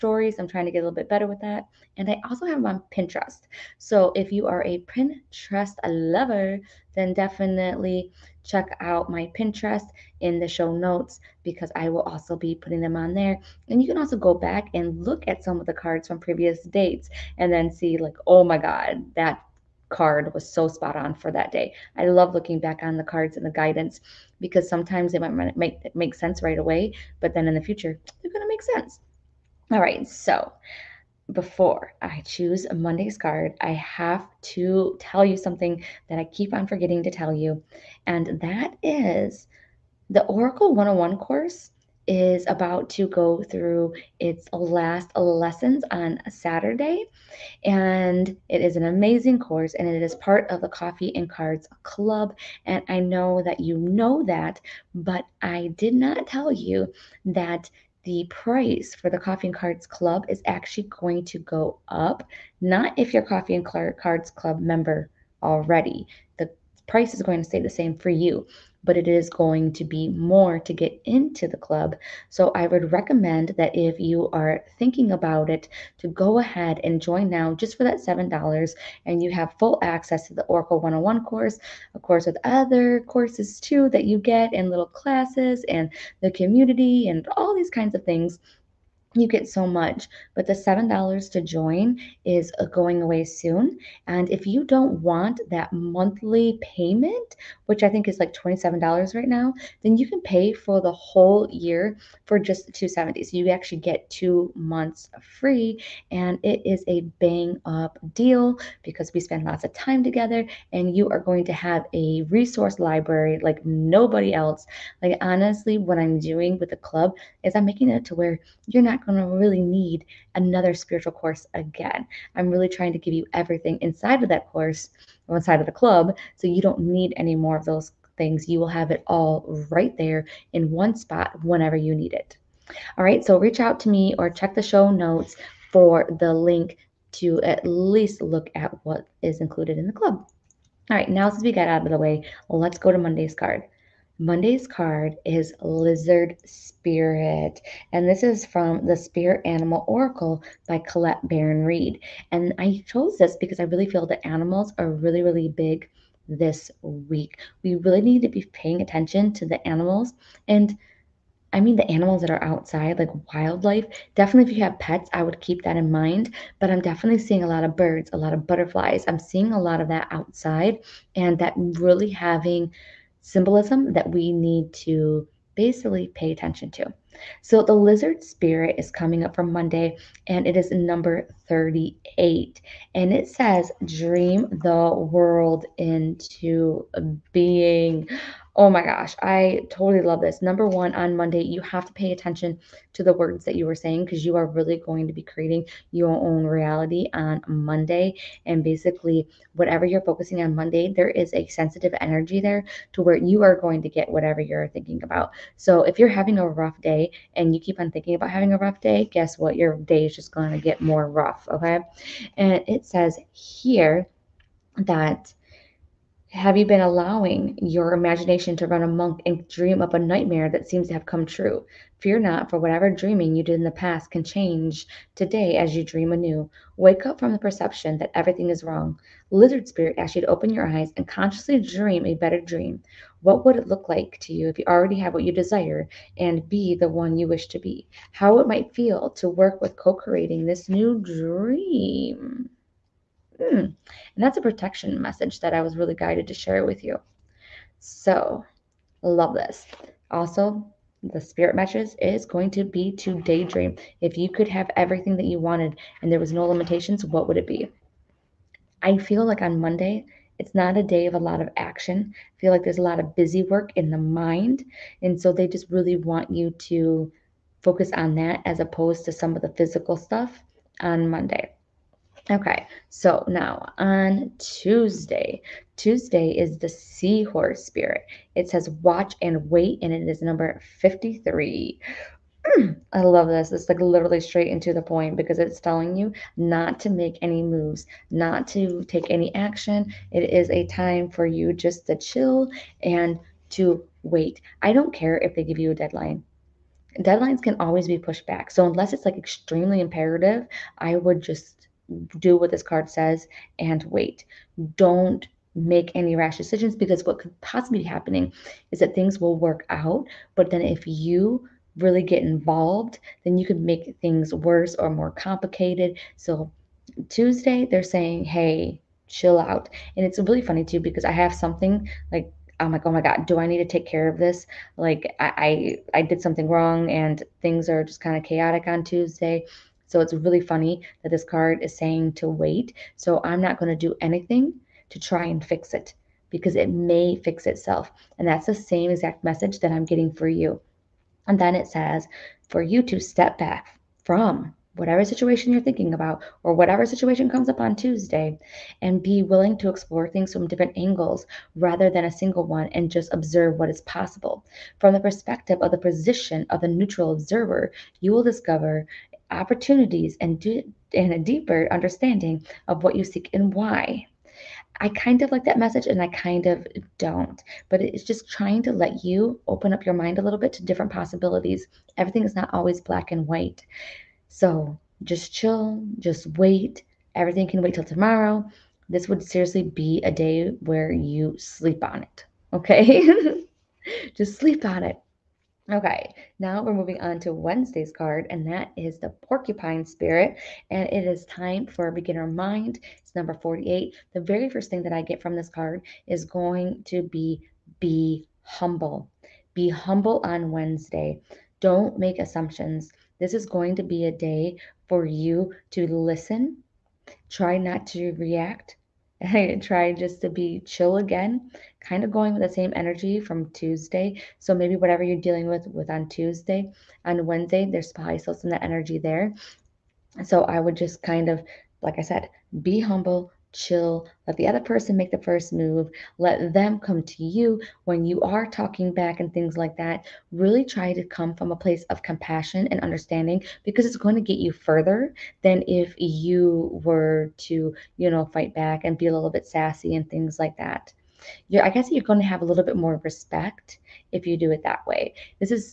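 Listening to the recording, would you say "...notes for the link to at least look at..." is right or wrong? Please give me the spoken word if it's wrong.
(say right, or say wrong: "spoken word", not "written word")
right.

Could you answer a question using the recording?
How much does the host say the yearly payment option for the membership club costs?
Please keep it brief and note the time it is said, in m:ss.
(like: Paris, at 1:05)
270, at 1:42.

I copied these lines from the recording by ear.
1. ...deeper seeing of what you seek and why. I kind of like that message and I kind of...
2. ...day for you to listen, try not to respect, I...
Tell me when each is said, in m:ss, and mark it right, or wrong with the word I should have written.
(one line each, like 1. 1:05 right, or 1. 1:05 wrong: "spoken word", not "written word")
1. 6:01 wrong: "understanding", not "seeing"
2. 6:44 wrong: "react", not "respect".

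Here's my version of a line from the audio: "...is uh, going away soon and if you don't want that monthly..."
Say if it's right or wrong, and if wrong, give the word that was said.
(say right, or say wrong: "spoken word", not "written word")
right.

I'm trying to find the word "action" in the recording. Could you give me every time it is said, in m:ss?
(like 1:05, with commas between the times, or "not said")
4:21, 4:49.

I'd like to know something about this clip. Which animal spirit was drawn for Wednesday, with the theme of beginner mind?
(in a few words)
Porcupine.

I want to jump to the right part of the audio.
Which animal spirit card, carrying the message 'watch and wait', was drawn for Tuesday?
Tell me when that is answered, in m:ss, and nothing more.
4:36.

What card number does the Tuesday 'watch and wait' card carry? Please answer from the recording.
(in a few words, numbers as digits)
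53.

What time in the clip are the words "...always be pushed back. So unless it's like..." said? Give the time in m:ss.
4:57.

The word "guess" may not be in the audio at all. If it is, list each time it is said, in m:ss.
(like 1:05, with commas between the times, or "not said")
3:29, 7:21.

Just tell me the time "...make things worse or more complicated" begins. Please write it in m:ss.
5:13.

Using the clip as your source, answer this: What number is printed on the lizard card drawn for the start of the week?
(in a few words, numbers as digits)
38.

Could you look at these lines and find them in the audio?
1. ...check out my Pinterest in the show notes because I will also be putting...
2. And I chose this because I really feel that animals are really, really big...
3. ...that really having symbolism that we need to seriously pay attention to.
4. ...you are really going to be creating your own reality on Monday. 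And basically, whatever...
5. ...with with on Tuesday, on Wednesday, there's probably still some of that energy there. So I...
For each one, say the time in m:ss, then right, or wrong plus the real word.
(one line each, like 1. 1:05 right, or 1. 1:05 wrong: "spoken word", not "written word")
1. 0:08 right
2. 2:32 right
3. 2:51 wrong: "basically", not "seriously"
4. 3:14 right
5. 6:55 right.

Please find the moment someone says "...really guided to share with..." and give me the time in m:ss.
4:05.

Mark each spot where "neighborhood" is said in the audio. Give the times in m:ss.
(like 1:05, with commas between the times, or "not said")
not said.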